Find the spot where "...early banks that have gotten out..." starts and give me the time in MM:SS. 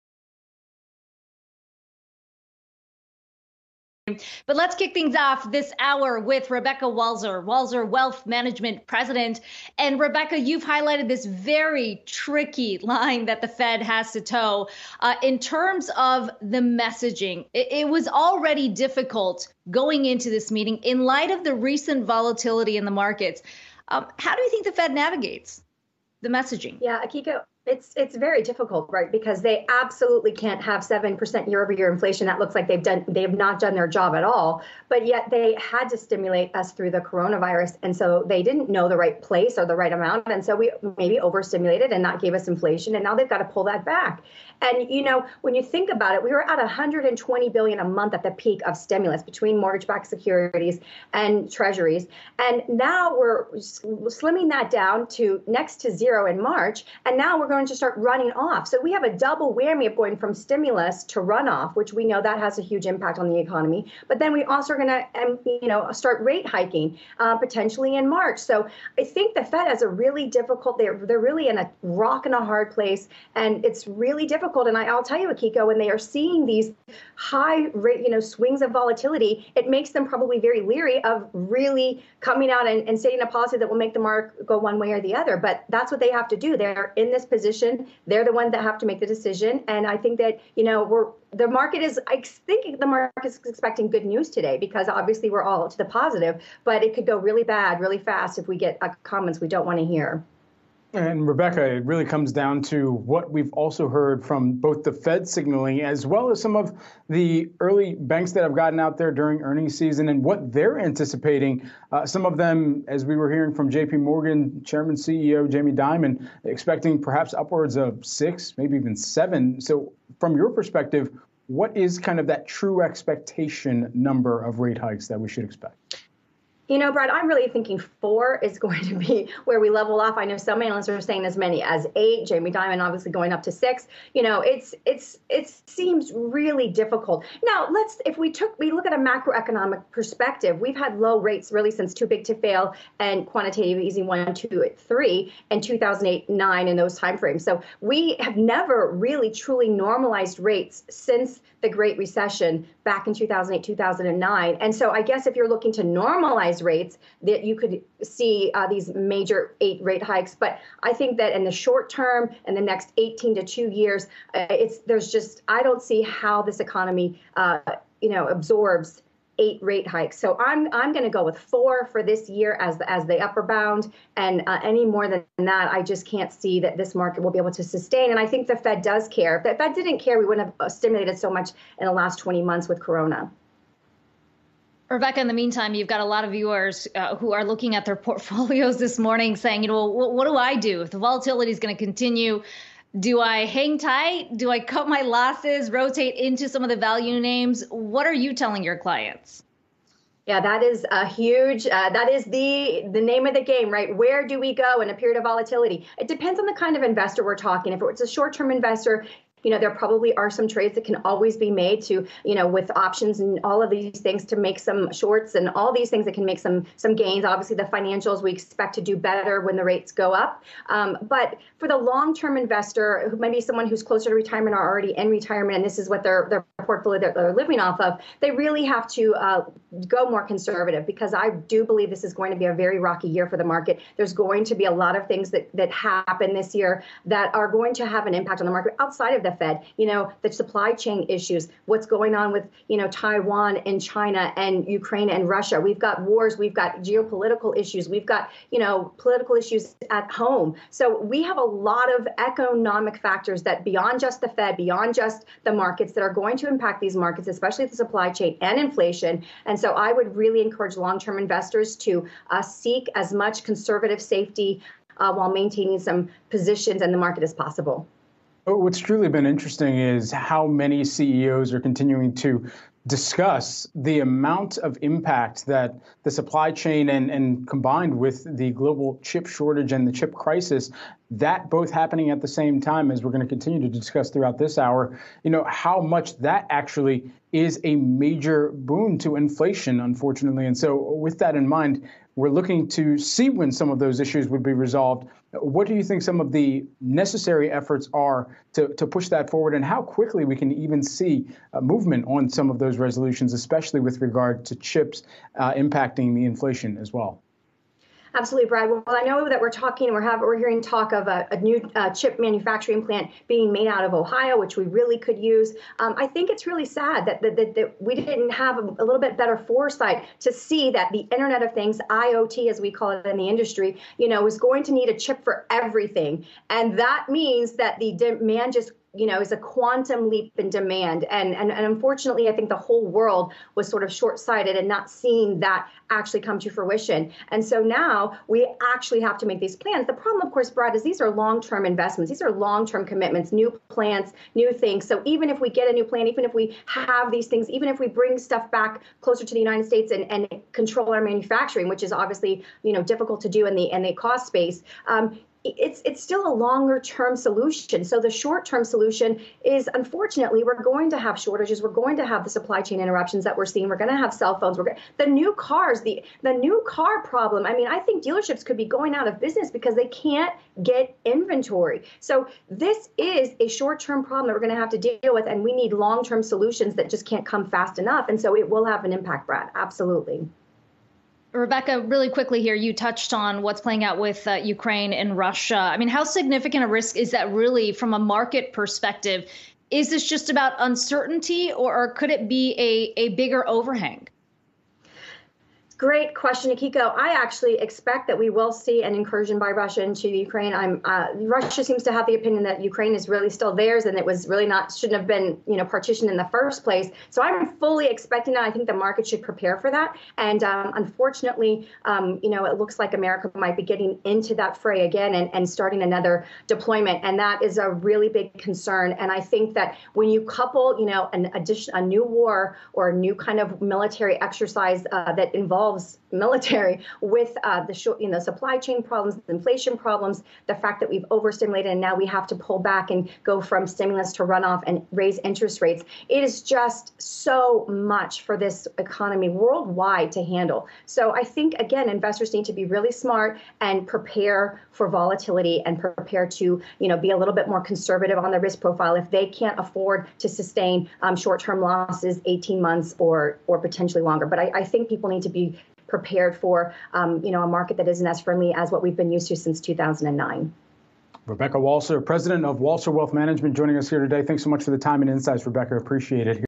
01:47.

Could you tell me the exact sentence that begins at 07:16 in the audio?
It is just so much for this economy worldwide to handle.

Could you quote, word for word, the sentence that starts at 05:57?
So the short term solution is unfortunately we're going to have shortages.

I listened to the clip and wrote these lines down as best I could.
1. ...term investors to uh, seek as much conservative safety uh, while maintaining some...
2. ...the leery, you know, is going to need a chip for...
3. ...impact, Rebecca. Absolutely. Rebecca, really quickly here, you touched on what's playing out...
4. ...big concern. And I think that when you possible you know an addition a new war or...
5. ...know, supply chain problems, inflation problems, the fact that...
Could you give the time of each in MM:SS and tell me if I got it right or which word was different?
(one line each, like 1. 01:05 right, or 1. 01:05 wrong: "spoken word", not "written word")
1. 04:20 right
2. 05:23 wrong: "industry", not "leery"
3. 06:18 wrong: "Brad", not "Rebecca"
4. 06:58 wrong: "couple", not "possible"
5. 07:08 right.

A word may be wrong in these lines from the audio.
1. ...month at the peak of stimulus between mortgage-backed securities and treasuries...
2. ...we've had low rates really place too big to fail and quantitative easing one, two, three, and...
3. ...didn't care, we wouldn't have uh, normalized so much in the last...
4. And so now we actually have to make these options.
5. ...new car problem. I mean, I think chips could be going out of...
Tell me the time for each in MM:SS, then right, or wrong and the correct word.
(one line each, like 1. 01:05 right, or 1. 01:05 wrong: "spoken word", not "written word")
1. 00:47 right
2. 02:20 wrong: "since", not "place"
3. 02:59 wrong: "stimulated", not "normalized"
4. 05:37 wrong: "plans", not "options"
5. 06:06 wrong: "dealerships", not "chips".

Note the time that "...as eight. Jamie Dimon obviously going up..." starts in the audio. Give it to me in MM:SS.
02:11.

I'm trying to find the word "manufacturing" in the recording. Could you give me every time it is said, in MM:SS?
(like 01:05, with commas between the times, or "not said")
05:12, 05:51.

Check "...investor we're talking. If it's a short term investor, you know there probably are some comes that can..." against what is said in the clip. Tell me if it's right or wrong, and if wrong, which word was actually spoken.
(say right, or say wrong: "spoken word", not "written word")
wrong: "trades", not "comes".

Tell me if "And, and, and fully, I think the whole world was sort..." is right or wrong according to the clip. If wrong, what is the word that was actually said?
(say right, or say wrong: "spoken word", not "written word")
wrong: "unfortunately", not "fully".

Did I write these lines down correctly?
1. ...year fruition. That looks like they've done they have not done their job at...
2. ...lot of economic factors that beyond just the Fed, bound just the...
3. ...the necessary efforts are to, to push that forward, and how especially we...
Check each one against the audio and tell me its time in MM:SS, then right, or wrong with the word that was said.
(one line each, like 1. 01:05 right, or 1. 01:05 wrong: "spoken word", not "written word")
1. 00:31 wrong: "inflation", not "fruition"
2. 04:11 wrong: "beyond", not "bound"
3. 04:56 wrong: "quickly", not "especially".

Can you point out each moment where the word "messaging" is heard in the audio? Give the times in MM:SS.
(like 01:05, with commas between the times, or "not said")
00:16, 00:26.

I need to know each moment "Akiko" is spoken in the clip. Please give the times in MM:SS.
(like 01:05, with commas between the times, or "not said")
00:27, 01:15, 06:36.